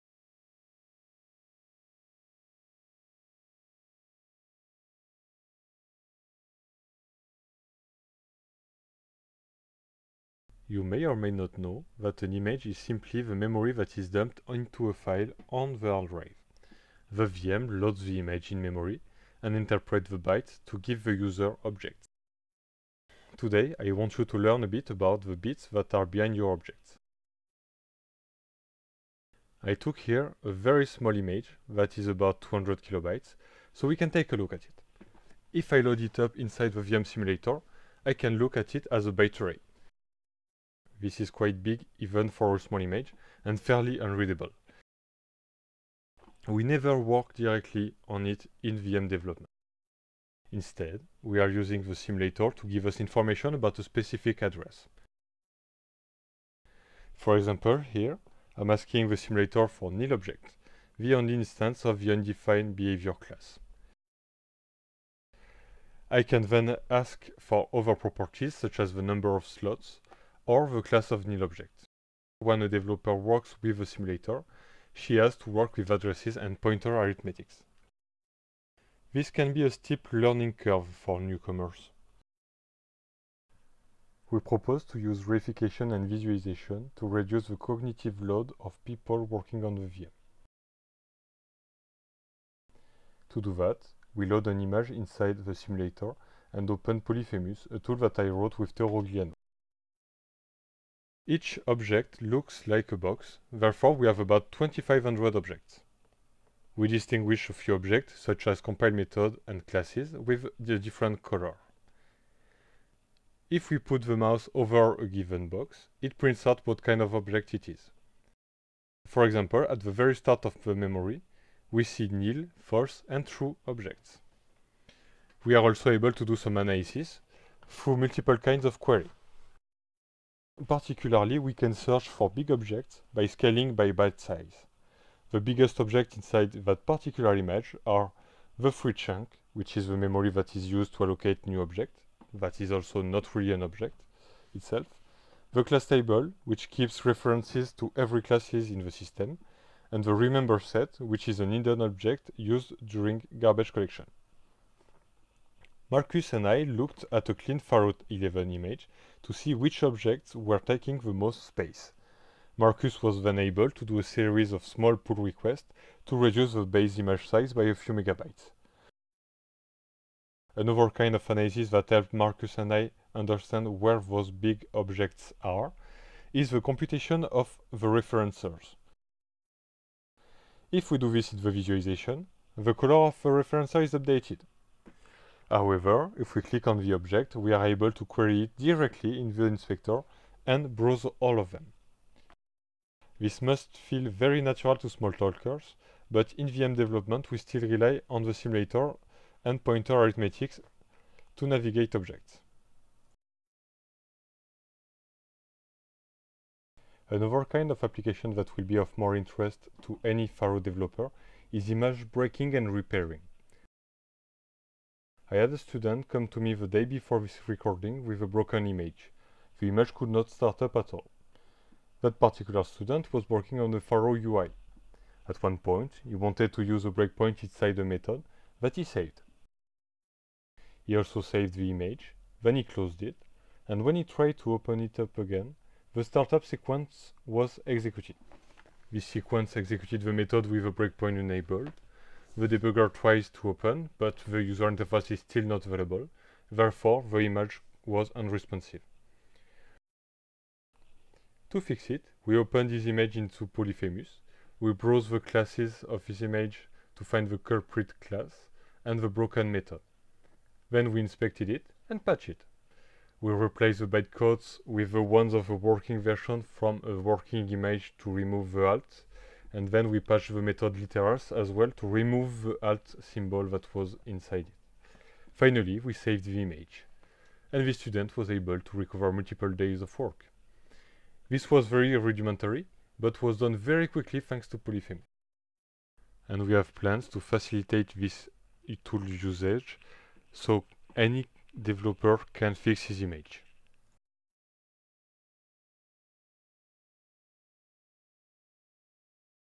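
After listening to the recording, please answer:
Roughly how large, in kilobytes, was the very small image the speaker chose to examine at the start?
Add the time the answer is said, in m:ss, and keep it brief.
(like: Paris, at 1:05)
200 kilobytes, at 0:32.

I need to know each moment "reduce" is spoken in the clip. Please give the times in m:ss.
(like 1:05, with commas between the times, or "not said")
1:27, 2:46.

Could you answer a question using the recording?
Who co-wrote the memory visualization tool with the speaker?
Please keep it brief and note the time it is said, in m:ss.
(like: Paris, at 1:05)
Théo Rogliano, at 1:38.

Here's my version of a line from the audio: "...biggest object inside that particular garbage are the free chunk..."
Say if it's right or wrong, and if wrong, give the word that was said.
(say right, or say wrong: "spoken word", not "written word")
wrong: "image", not "garbage".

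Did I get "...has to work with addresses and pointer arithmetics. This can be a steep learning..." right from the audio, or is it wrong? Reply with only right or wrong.
right.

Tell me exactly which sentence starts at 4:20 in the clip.
Then we inspected it and patched it.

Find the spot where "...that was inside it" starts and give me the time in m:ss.
4:33.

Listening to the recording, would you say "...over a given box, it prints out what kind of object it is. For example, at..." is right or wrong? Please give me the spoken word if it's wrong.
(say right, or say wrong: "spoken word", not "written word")
right.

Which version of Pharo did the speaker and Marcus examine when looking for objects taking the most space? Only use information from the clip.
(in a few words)
Pharo 11.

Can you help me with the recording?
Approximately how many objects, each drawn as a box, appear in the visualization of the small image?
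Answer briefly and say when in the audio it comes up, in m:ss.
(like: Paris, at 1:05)
2500, at 1:44.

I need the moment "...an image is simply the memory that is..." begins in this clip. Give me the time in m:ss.
0:12.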